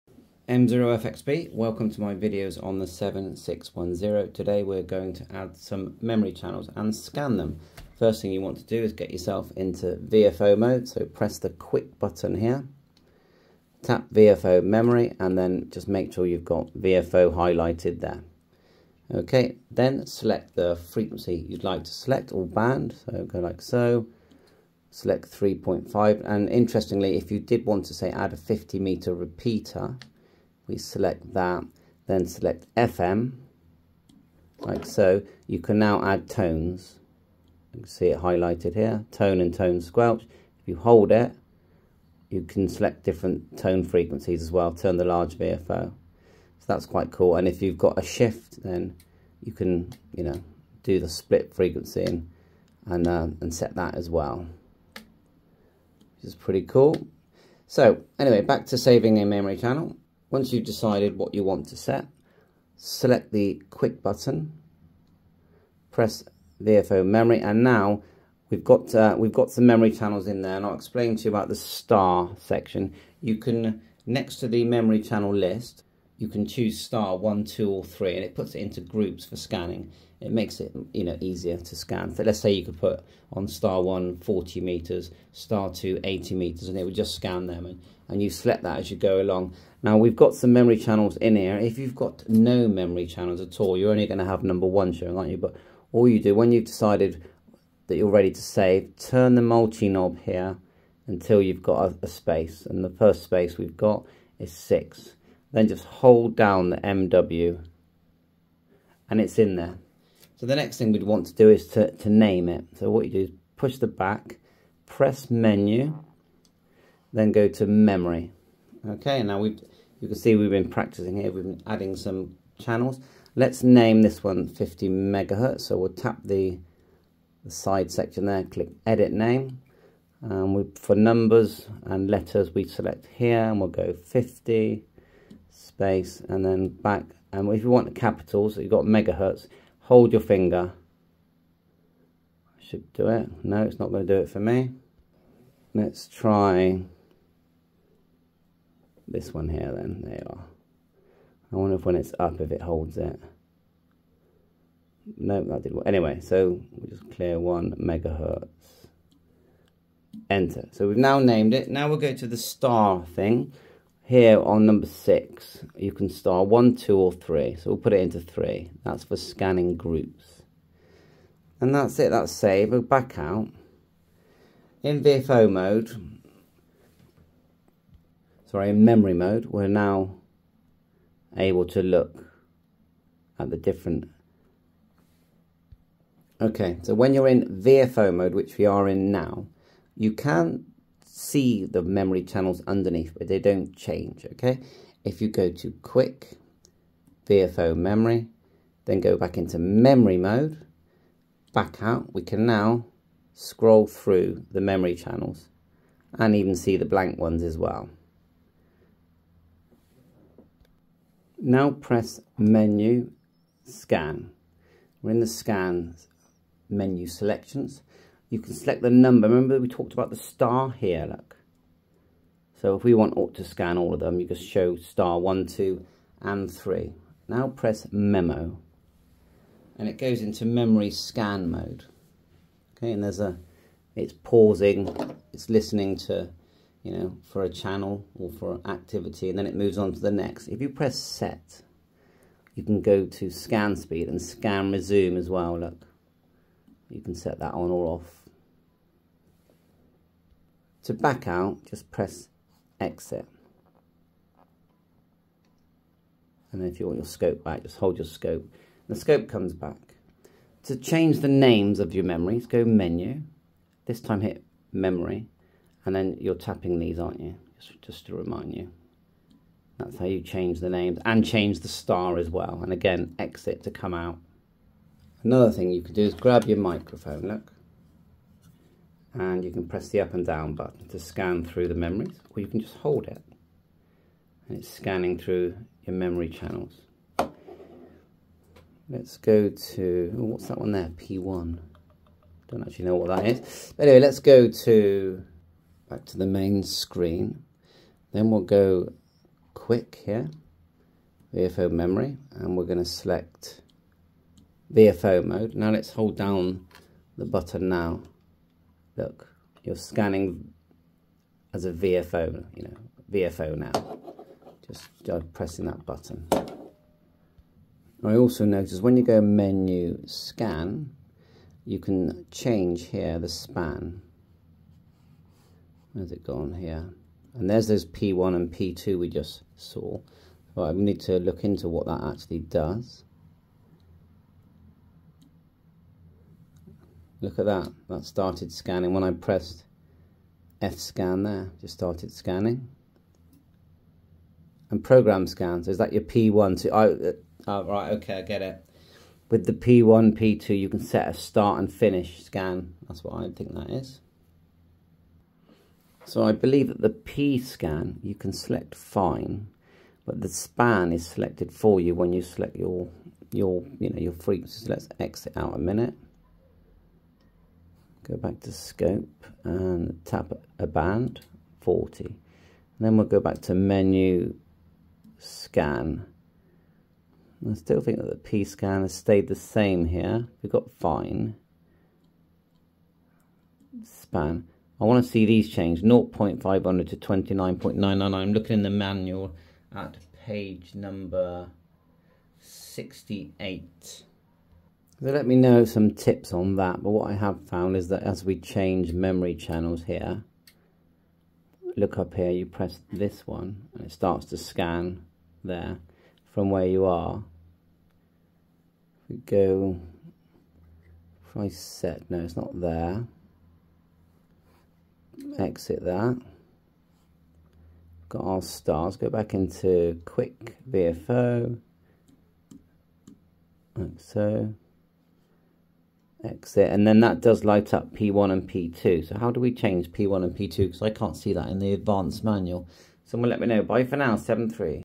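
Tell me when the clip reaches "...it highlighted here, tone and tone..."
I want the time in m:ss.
0:38.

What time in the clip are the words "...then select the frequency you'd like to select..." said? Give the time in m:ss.
0:19.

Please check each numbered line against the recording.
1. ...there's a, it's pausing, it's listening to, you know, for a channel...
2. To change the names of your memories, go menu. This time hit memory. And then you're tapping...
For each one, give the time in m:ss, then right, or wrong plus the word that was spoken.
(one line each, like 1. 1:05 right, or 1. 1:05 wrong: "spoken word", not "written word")
1. 3:53 right
2. 4:20 right.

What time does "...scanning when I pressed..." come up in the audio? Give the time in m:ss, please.
5:38.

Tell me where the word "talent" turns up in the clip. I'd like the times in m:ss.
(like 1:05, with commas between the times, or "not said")
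not said.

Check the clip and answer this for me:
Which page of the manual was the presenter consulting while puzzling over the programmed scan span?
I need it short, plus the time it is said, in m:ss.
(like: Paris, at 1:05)
68, at 6:32.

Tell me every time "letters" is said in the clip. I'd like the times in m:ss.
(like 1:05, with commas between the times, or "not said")
2:12.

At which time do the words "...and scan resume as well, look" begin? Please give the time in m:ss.
4:04.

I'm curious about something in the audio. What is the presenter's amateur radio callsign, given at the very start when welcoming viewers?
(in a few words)
M0FXB.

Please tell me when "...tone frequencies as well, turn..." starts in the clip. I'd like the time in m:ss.
0:43.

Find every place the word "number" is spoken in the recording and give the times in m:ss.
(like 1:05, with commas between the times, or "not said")
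1:34, 2:10, 2:44, 3:38, 6:30.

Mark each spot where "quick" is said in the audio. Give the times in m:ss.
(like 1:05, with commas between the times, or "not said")
0:11, 1:03, 3:15, 4:59, 7:00.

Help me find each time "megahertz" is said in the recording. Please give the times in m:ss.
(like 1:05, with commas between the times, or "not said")
2:04, 2:18, 2:37.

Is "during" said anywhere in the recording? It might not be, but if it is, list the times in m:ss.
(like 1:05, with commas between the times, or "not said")
not said.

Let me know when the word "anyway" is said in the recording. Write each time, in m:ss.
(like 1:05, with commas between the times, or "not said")
0:58, 2:35, 4:53.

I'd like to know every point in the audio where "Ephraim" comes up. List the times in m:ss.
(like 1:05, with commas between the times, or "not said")
not said.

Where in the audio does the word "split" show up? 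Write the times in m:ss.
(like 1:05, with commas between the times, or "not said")
0:51.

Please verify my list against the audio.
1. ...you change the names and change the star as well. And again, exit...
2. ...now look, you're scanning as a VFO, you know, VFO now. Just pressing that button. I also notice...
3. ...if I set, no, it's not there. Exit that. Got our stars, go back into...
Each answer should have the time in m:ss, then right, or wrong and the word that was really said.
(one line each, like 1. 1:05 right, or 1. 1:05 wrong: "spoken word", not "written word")
1. 4:30 right
2. 5:07 right
3. 6:51 right.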